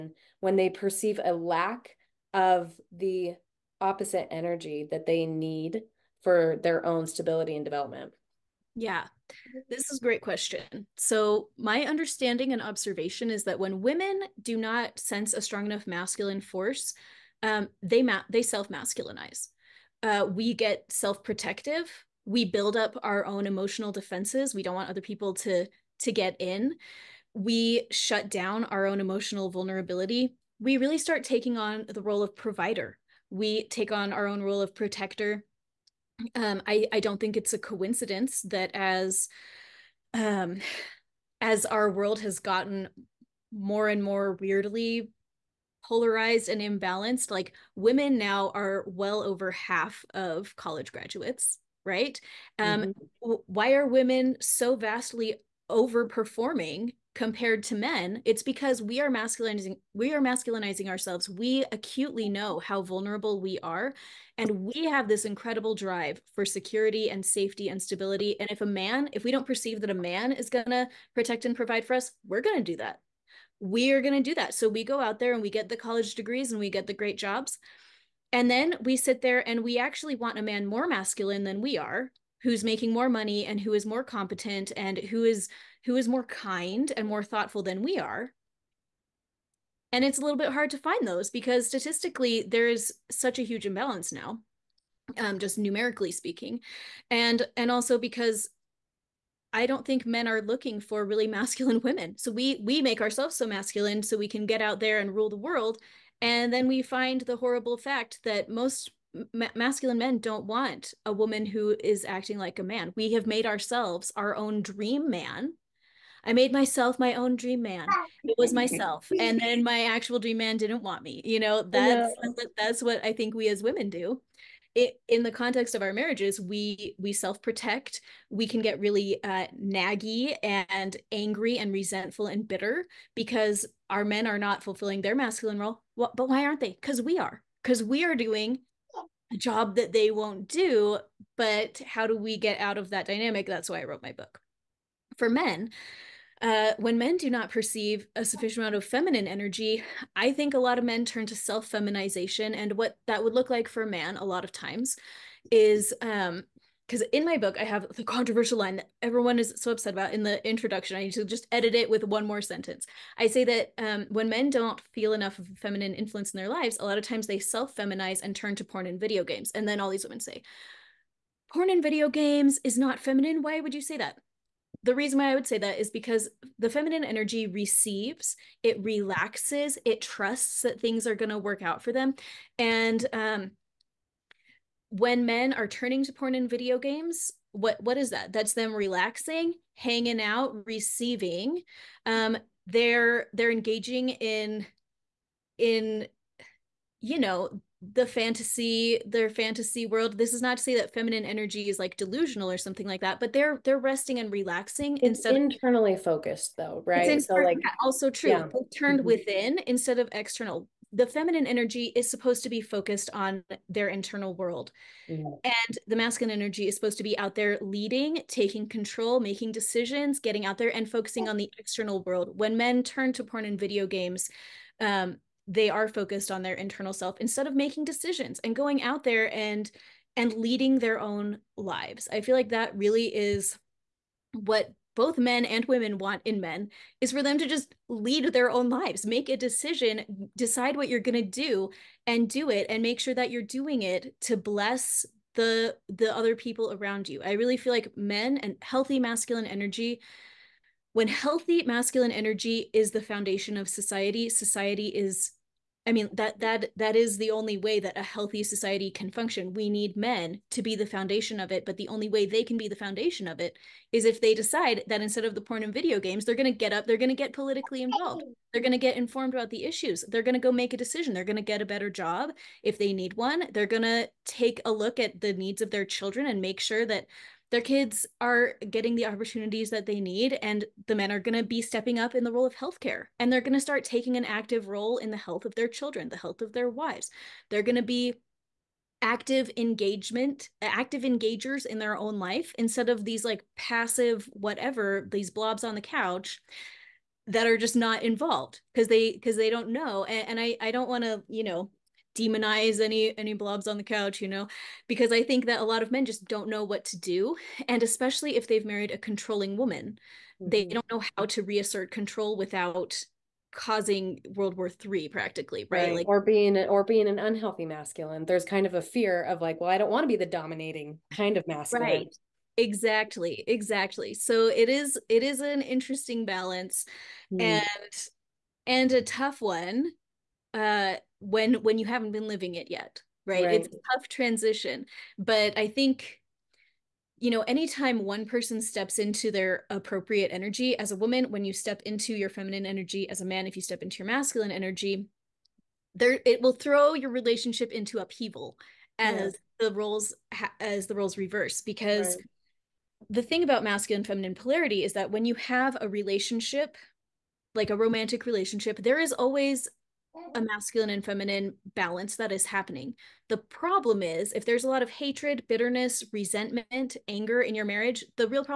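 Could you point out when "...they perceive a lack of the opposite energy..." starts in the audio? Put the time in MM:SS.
00:00.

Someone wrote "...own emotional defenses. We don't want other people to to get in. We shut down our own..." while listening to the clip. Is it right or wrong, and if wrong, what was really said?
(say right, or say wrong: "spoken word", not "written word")
right.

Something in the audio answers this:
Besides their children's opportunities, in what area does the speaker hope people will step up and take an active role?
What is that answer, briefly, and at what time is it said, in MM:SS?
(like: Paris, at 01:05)
Healthcare, at 04:42.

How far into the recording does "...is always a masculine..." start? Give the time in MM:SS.
05:58.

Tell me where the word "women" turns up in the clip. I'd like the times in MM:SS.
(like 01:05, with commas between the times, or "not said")
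00:13, 00:47, 00:53, 01:41, 02:03, 02:50, 03:55.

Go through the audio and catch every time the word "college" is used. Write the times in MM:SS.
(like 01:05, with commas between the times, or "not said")
00:50, 01:15.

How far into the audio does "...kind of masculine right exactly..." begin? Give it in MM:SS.
05:21.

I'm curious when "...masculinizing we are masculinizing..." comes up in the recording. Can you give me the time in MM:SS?
00:59.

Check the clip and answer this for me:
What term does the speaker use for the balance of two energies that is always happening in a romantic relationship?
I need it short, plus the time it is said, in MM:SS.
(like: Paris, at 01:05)
Masculine feminine polarity, at 05:53.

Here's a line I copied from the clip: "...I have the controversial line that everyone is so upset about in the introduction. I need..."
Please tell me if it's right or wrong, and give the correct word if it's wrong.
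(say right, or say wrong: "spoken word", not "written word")
right.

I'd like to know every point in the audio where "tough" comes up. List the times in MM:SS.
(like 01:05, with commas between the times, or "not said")
05:29, 05:33.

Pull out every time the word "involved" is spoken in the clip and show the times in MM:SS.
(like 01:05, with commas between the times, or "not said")
04:27, 04:58.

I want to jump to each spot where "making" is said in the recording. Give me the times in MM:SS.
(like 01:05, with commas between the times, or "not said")
01:22, 03:39, 03:47.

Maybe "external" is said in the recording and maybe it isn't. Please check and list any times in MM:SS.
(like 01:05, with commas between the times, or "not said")
03:30, 03:41.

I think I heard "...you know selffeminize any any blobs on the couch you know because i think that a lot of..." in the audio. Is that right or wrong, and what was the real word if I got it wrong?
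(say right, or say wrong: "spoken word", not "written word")
wrong: "demonize", not "selffeminize".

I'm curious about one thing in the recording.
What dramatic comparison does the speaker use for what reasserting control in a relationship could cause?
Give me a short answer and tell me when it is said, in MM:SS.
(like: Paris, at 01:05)
World War 3, at 05:14.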